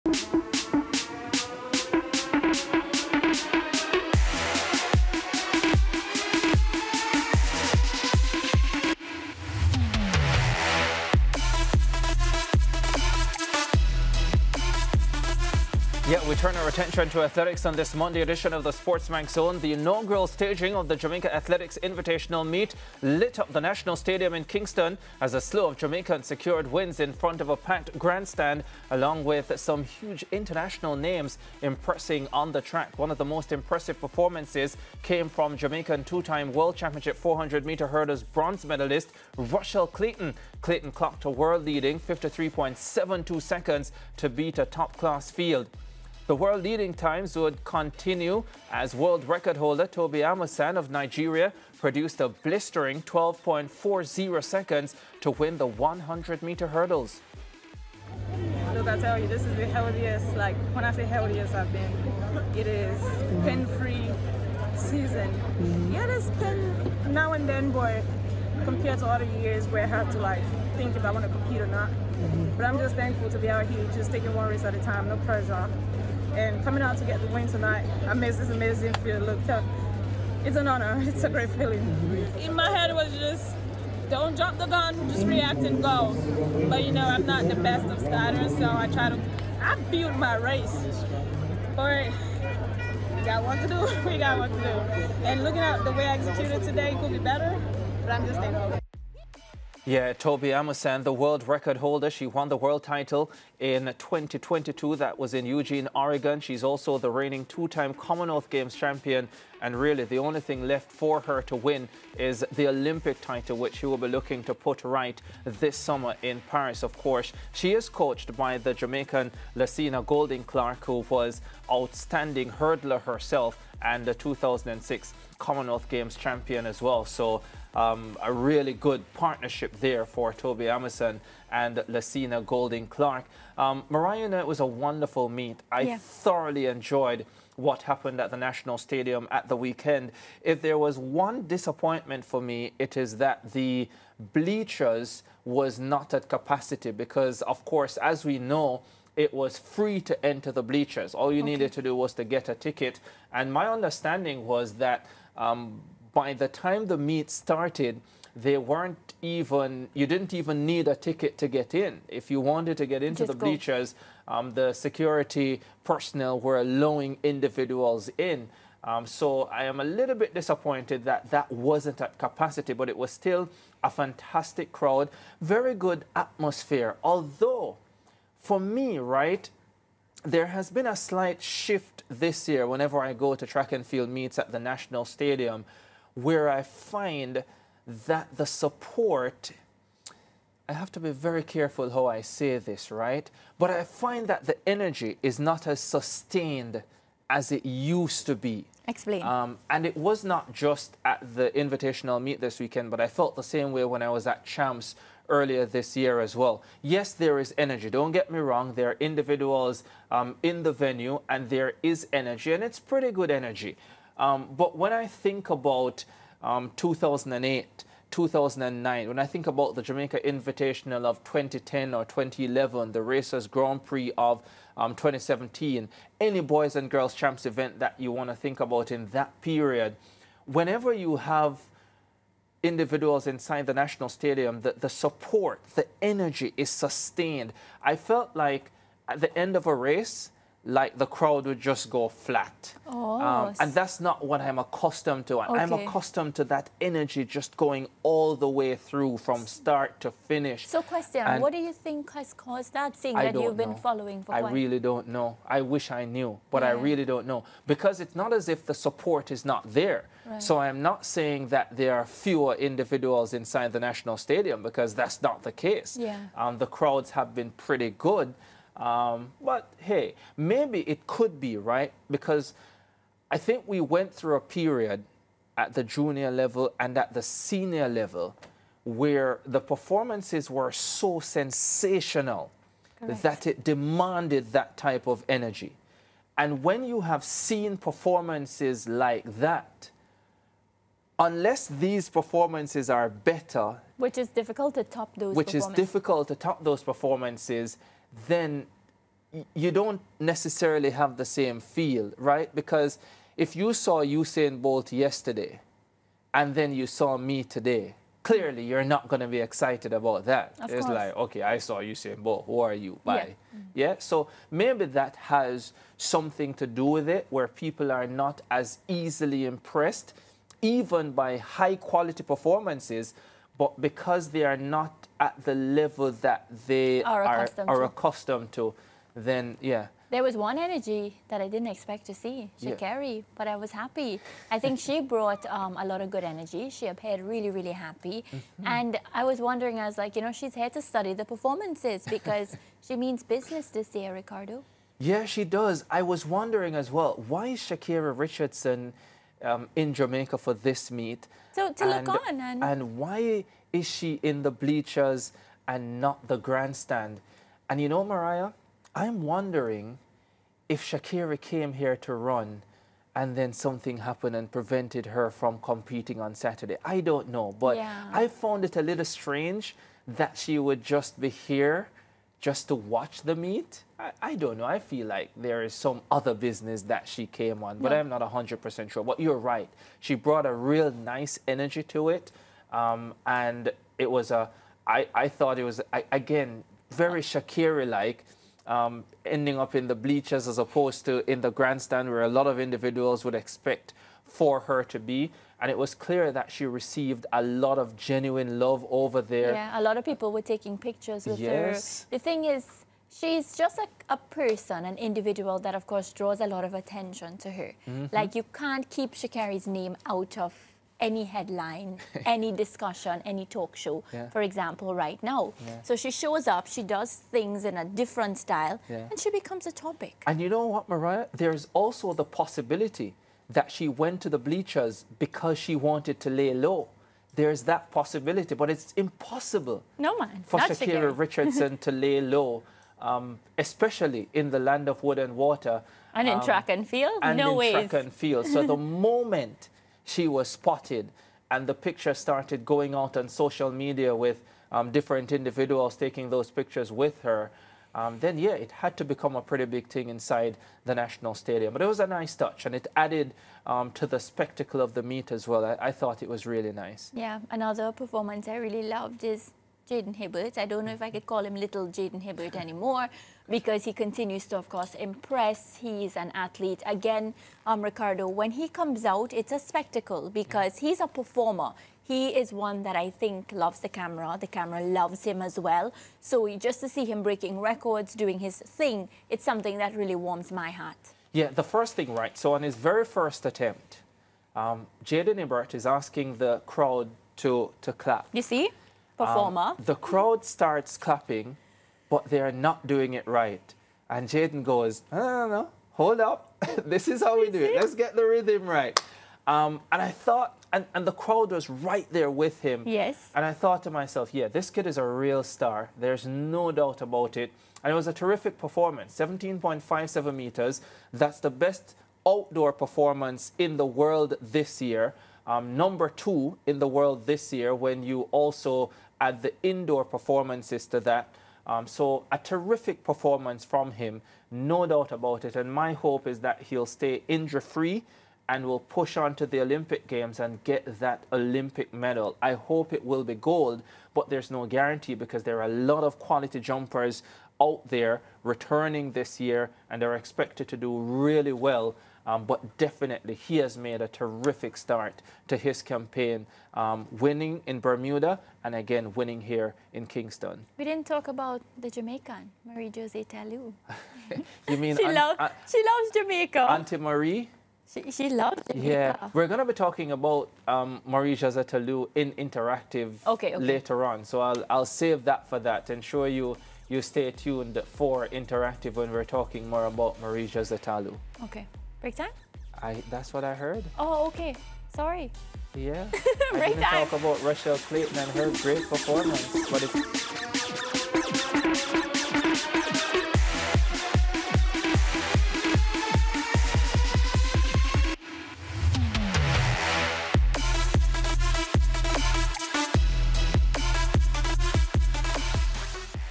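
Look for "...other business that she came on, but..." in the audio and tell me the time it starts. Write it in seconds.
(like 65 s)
376 s.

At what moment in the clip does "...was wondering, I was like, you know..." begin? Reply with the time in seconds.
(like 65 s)
339 s.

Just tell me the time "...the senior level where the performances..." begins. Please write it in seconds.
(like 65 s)
277 s.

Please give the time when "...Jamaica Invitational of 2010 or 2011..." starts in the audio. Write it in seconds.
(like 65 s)
219 s.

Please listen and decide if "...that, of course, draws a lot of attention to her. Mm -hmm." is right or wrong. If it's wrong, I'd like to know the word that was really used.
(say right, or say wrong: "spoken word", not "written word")
right.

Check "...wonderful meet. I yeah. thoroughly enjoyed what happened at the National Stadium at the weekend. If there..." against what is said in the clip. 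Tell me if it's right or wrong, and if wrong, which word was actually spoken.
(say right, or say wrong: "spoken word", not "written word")
right.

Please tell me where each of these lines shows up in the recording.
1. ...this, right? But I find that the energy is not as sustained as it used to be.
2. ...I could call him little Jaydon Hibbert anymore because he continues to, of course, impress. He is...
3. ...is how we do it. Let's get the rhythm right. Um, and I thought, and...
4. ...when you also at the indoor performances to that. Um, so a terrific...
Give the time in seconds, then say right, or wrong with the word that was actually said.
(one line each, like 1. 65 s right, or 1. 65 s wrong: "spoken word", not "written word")
1. 192 s right
2. 461 s right
3. 497 s right
4. 517 s right.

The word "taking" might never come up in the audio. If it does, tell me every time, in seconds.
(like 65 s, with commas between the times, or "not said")
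74 s, 400 s, 445 s.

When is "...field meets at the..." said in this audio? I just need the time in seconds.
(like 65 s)
183 s.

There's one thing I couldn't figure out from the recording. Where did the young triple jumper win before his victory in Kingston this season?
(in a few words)
Bermuda.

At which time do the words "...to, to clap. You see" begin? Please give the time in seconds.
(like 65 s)
487 s.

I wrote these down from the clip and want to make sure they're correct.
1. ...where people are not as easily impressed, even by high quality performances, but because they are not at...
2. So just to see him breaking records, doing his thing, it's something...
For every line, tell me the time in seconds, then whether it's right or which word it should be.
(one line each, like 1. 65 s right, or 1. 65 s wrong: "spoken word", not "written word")
1. 317 s right
2. 476 s right.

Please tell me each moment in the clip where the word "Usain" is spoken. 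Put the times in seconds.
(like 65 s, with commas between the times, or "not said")
304 s, 311 s.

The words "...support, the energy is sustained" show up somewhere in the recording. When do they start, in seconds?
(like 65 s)
234 s.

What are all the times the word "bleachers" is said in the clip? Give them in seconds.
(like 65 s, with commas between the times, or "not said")
144 s, 150 s, 163 s, 354 s, 389 s, 424 s.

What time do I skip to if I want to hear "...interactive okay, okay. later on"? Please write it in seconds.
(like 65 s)
562 s.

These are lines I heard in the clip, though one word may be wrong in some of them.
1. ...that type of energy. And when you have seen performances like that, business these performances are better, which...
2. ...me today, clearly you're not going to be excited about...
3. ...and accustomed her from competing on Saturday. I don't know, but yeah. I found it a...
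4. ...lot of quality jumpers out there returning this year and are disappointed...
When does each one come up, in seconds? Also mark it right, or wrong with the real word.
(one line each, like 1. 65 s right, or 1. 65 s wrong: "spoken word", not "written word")
1. 284 s wrong: "unless", not "business"
2. 307 s right
3. 364 s wrong: "prevented", not "accustomed"
4. 535 s wrong: "expected", not "disappointed".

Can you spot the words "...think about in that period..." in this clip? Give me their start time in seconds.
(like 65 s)
228 s.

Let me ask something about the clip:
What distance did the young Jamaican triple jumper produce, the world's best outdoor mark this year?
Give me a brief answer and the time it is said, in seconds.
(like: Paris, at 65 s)
17.57 meters, at 509 s.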